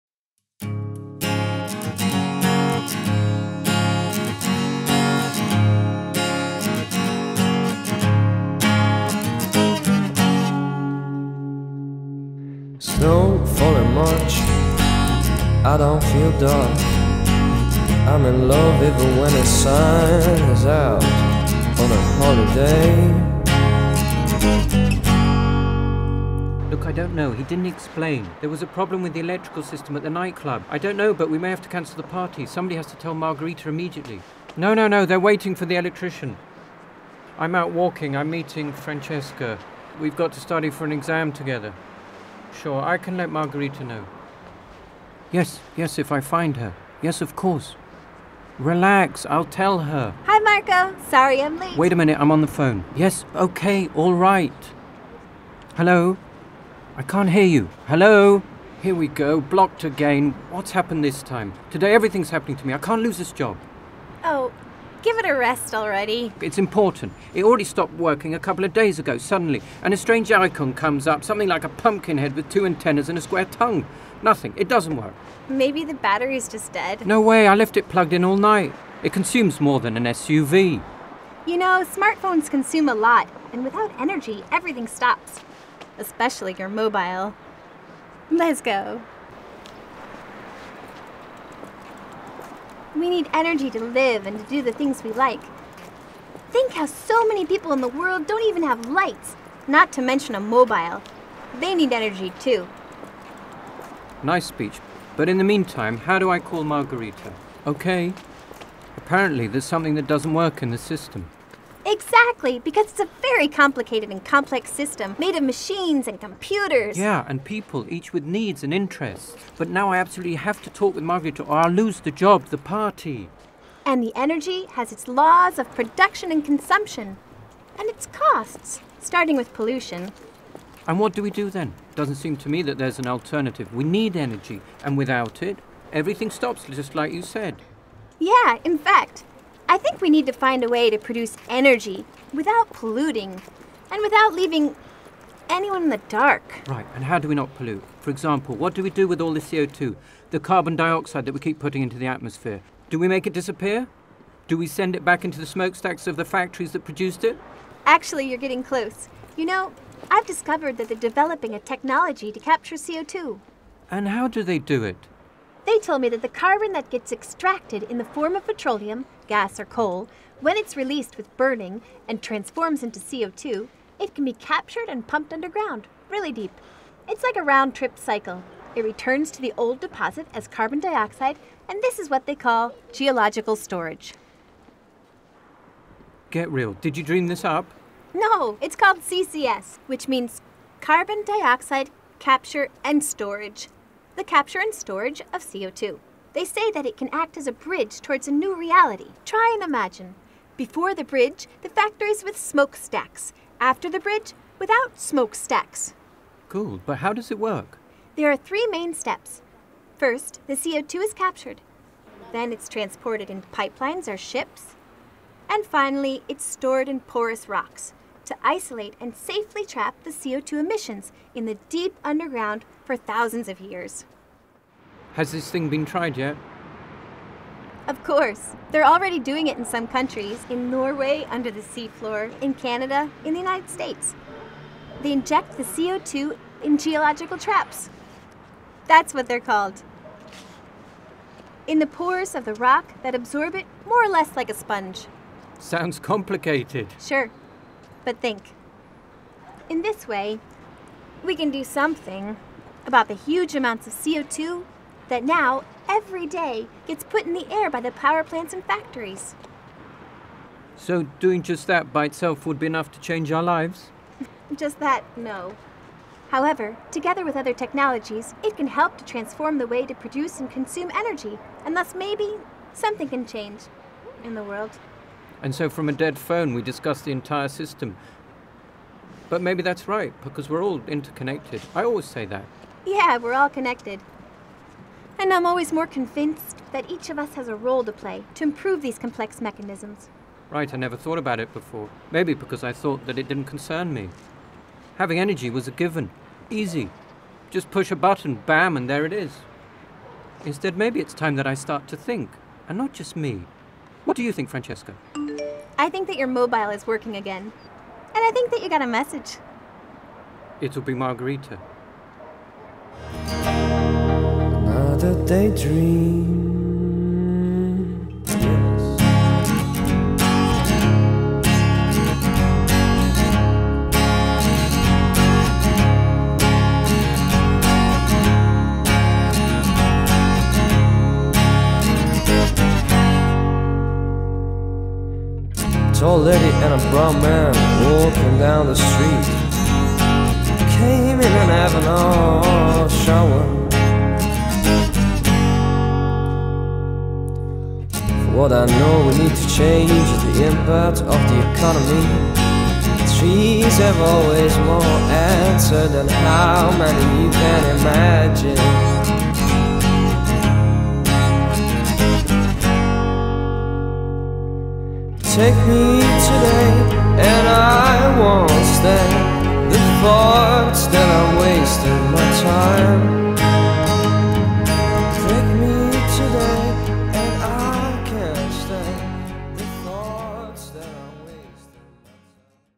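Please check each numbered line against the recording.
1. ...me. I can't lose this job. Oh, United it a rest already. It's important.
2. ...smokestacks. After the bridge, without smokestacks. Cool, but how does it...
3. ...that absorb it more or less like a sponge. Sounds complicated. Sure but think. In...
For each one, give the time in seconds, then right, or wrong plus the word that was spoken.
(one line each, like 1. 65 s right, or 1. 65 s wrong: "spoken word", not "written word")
1. 62 s wrong: "Give", not "United"
2. 202 s right
3. 243 s right.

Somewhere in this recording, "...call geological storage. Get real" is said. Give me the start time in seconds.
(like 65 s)
182 s.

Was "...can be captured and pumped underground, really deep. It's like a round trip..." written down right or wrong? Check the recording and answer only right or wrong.
right.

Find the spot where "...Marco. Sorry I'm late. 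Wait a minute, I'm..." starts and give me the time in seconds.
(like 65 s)
50 s.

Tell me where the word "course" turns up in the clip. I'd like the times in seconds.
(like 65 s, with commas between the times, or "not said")
47 s, 228 s.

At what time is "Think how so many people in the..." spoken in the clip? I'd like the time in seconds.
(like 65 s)
96 s.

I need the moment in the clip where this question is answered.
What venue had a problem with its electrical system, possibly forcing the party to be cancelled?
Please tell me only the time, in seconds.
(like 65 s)
30 s.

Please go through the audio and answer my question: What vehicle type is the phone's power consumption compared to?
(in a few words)
An SUV.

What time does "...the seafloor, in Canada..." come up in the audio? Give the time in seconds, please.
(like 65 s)
231 s.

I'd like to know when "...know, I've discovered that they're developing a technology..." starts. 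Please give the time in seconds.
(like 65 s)
159 s.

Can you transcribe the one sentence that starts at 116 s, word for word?
Yeah, and people, each with needs and interests.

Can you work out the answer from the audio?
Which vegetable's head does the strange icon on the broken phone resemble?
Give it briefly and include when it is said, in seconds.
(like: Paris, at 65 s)
Pumpkin, at 71 s.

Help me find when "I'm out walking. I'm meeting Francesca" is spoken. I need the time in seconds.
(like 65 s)
37 s.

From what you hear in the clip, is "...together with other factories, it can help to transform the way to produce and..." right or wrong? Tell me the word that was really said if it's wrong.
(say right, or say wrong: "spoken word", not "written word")
wrong: "technologies", not "factories".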